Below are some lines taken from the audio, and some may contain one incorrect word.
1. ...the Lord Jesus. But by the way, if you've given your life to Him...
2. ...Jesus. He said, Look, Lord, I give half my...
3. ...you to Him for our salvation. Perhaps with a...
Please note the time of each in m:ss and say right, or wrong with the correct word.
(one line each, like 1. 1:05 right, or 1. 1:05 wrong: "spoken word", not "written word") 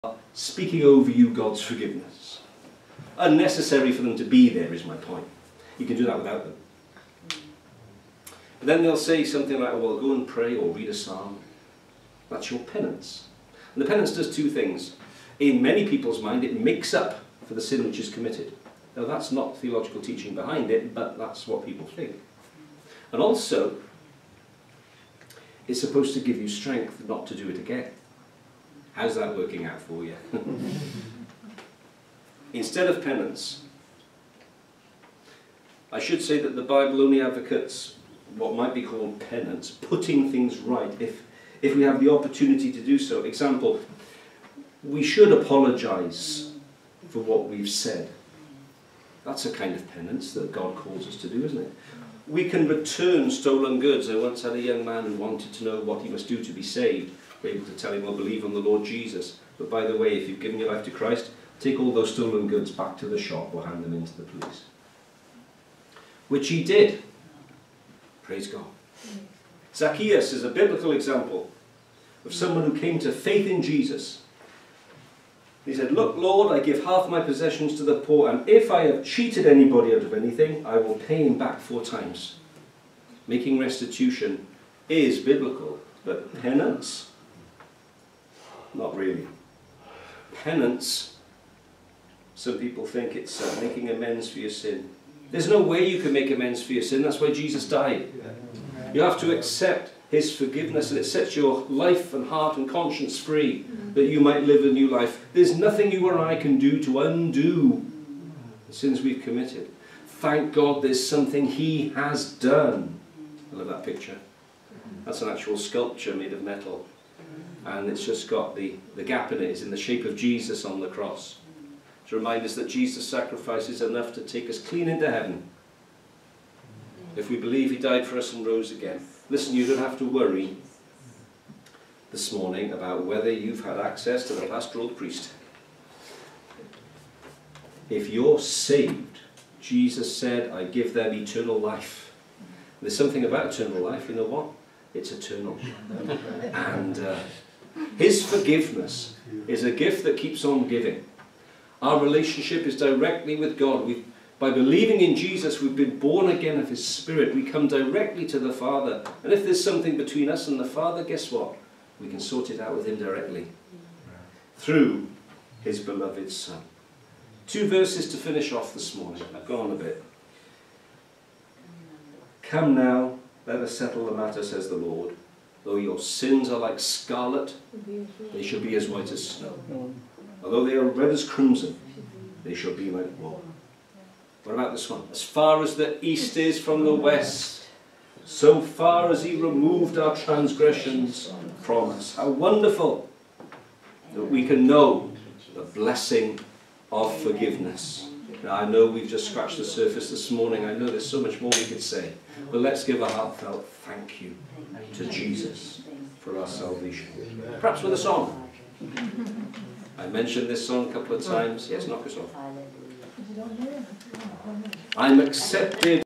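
1. 0:58 wrong: "Christ", not "Him"
2. 1:13 right
3. 3:24 wrong: "Jesus", not "Him".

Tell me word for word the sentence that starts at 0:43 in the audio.
Example, we should apologize for what we've said.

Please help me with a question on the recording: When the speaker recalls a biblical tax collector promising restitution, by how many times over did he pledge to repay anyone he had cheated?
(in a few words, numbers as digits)
4.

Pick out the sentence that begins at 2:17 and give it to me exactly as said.
If you're saved, Jesus said, I give them eternal life.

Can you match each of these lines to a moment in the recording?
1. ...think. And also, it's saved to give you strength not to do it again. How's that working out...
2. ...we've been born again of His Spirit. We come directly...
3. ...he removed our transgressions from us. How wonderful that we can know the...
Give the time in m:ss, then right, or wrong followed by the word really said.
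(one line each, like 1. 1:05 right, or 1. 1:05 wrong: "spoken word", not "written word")
1. 0:21 wrong: "supposed", not "saved"
2. 2:35 right
3. 3:09 right.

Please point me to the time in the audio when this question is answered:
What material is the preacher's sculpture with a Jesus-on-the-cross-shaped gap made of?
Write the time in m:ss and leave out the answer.
1:56.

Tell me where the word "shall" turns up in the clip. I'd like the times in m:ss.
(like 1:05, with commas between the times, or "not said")
2:58, 3:02.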